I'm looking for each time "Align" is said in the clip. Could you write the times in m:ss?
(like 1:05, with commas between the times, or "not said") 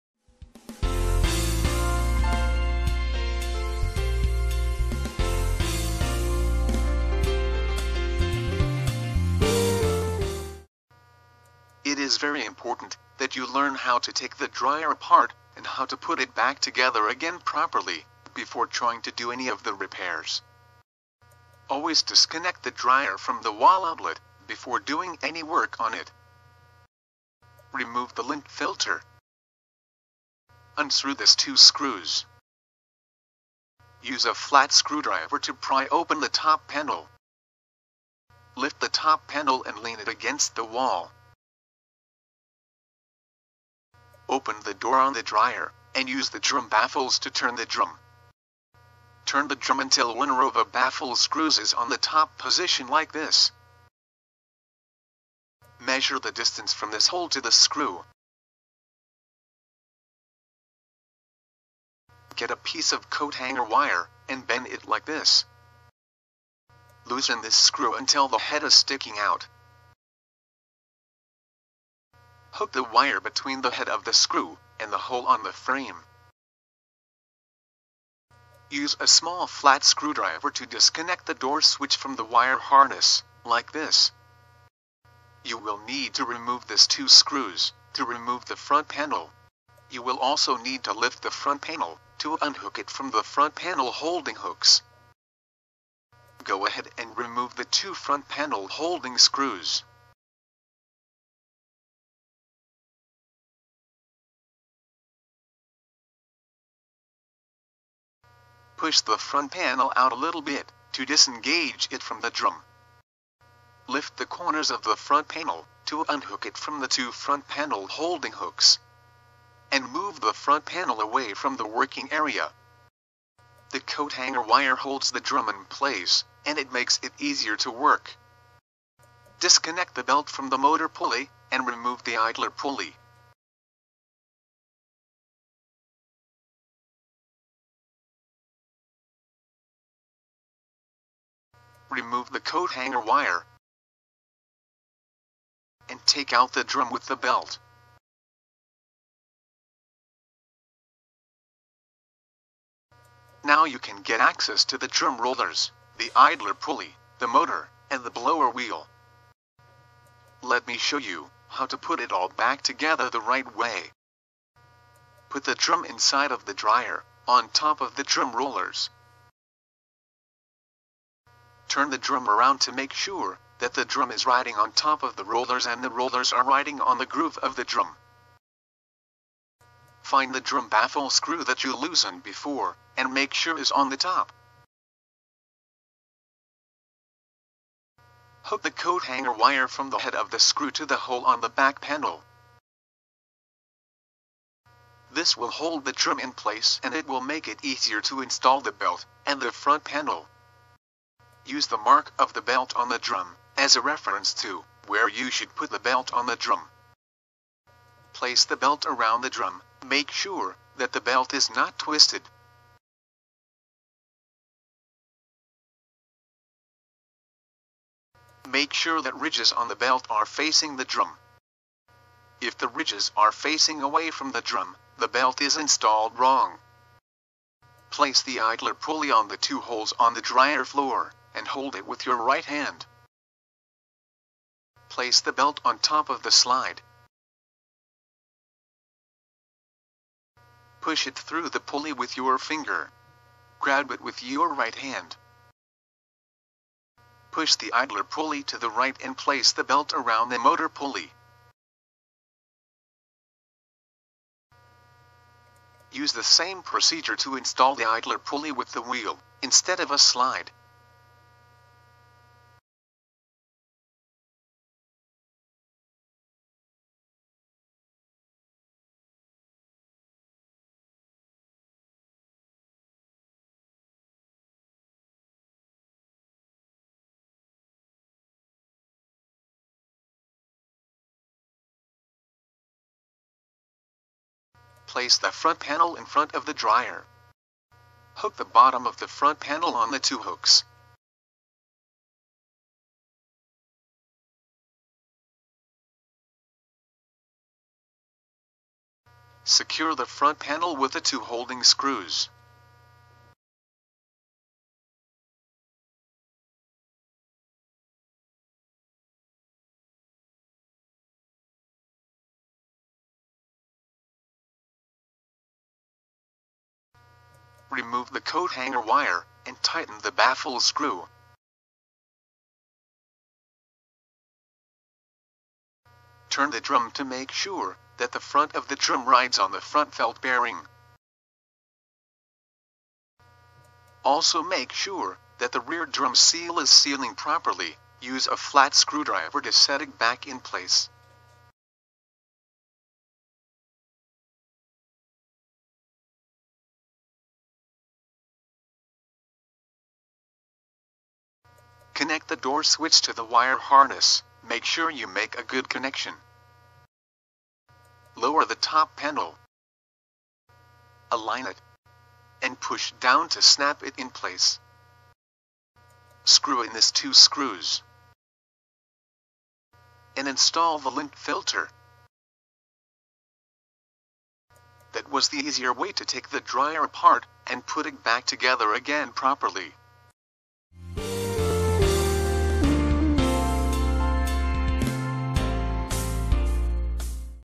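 6:01.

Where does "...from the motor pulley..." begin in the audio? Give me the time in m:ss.
2:10.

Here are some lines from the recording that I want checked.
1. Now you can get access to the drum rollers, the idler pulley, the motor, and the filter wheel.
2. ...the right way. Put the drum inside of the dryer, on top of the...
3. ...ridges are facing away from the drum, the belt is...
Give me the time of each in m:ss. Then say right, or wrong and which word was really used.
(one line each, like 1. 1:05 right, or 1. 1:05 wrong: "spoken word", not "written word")
1. 2:33 wrong: "blower", not "filter"
2. 2:43 right
3. 3:42 right.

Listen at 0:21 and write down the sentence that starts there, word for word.
Always disconnect the dryer from the wall outlet before doing any work on it.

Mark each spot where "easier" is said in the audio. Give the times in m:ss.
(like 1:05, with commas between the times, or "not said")
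2:07, 3:17, 6:15.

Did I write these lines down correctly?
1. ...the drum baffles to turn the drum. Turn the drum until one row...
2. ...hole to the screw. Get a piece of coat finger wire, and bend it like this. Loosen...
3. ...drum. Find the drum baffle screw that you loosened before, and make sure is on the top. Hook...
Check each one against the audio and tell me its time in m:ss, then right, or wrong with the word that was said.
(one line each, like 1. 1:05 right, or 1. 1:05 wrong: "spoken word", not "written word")
1. 0:46 right
2. 0:57 wrong: "hanger", not "finger"
3. 2:57 right.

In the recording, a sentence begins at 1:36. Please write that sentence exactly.
Go ahead and remove the two front panel holding screws.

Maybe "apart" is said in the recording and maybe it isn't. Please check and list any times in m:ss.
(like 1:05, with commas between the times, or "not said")
0:14, 6:16.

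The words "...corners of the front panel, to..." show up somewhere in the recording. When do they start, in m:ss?
1:54.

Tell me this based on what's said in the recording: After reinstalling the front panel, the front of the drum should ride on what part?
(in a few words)
front felt bearing.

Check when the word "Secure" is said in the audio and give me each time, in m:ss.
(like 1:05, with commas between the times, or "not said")
4:59.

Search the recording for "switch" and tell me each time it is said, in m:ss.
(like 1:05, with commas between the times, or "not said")
1:21, 5:52.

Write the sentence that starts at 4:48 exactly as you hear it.
Hook the bottom of the front panel on the two hooks.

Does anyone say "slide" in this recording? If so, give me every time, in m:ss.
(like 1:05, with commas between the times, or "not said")
3:56, 4:19.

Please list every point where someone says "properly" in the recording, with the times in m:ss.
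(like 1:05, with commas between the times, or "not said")
0:17, 5:37, 6:19.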